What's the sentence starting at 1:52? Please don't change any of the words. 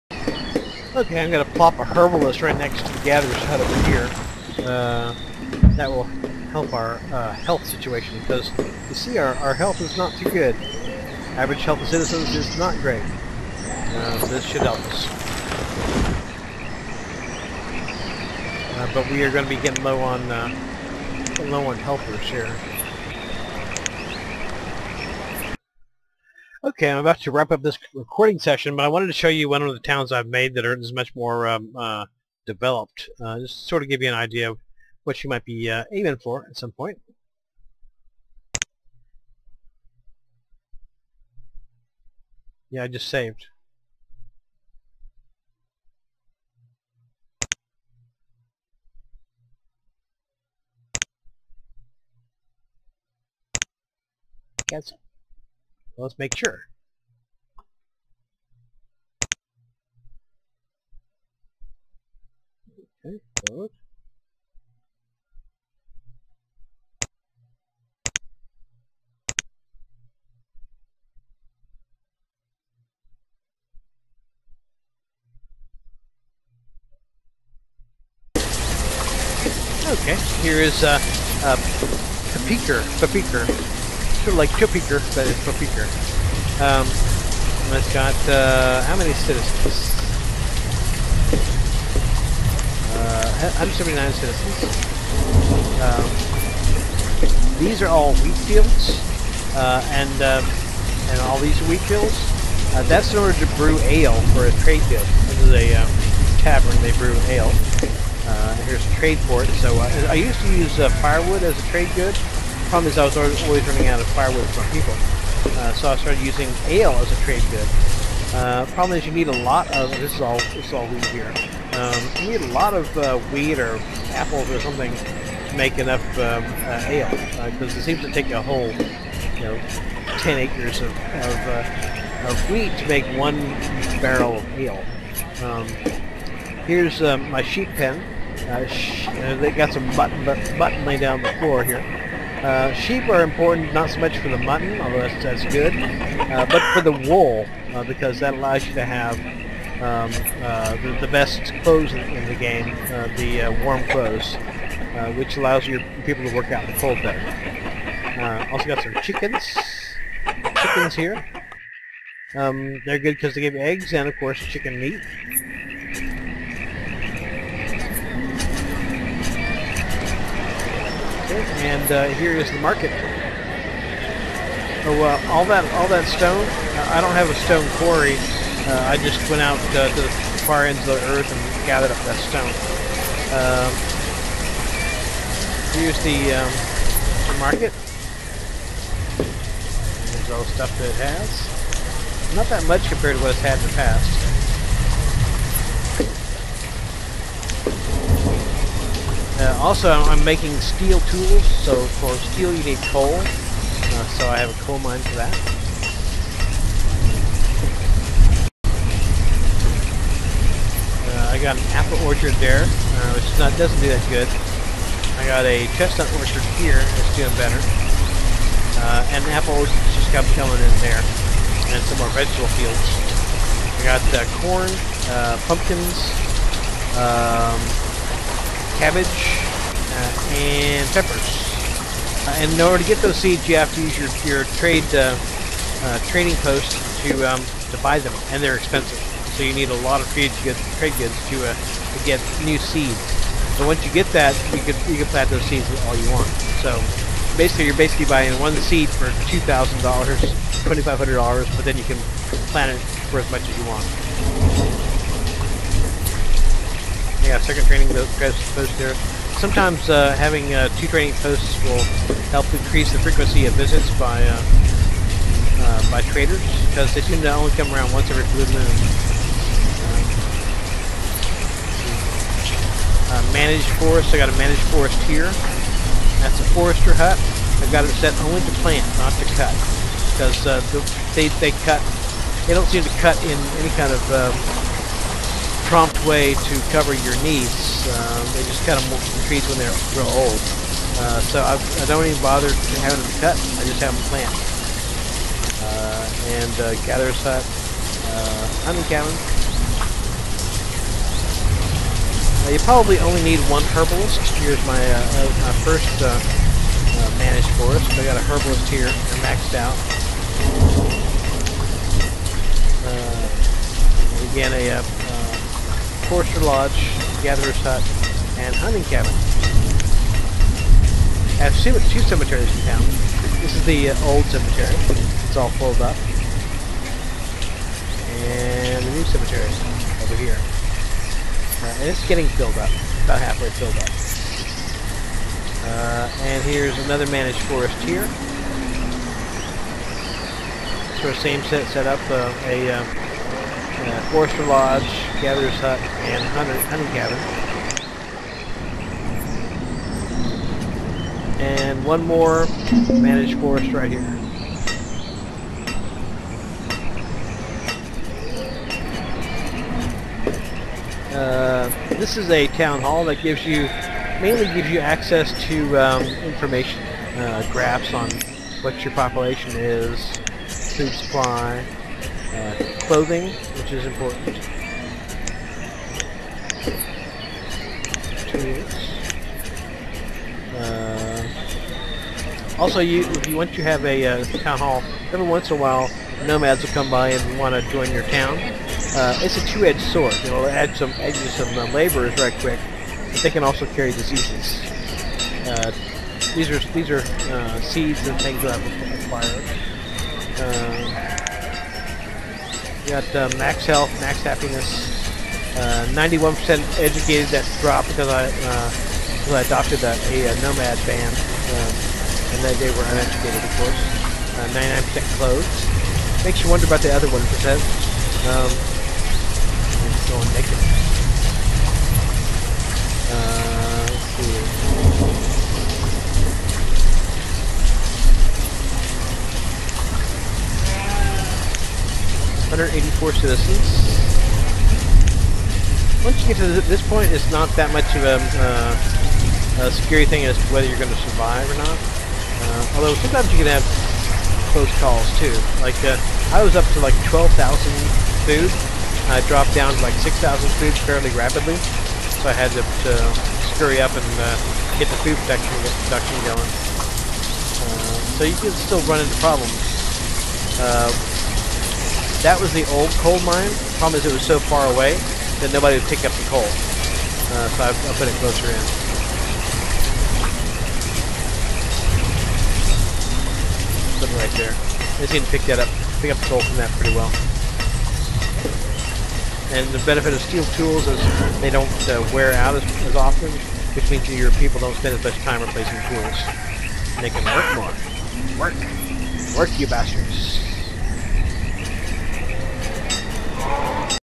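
Problem is, I was always running out of firewood for people.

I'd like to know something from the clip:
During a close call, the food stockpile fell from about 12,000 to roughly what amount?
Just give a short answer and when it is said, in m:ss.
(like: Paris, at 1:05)
6,000, at 7:30.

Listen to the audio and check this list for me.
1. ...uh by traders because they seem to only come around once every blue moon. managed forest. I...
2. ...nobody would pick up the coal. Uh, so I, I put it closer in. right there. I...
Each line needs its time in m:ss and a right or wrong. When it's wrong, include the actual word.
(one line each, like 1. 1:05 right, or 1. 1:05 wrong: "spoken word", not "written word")
1. 4:25 right
2. 7:45 right.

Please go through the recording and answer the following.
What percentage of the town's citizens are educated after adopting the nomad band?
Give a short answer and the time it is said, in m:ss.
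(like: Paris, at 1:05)
91%, at 6:45.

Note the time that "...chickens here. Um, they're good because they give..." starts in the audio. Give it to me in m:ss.
2:40.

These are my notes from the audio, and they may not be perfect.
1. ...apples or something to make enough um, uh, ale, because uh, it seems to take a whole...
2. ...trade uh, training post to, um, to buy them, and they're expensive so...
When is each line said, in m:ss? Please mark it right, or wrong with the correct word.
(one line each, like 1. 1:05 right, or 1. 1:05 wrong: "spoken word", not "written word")
1. 2:04 right
2. 3:54 right.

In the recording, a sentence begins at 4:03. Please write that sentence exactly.
So once you get that, you can you can plant those seeds all you want.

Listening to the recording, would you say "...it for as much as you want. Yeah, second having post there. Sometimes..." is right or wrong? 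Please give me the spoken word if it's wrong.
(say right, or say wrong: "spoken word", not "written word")
wrong: "training", not "having".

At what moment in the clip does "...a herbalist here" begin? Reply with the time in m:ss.
5:08.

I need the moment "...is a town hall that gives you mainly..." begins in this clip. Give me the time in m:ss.
6:02.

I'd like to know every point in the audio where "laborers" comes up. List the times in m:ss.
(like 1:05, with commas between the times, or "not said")
6:31.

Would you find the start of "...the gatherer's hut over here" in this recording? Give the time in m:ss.
0:02.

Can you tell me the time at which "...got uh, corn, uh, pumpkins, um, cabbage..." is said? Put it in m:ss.
3:43.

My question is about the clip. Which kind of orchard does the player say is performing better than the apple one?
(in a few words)
Chestnut orchard.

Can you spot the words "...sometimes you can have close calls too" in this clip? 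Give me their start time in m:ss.
7:22.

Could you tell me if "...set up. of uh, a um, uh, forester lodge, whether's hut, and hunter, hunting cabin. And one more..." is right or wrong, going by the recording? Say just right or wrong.
wrong.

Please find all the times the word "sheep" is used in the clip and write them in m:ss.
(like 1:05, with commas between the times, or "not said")
2:17, 2:22.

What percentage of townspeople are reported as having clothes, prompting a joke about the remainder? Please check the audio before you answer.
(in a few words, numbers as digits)
99%.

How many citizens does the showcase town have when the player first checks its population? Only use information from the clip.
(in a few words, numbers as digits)
179.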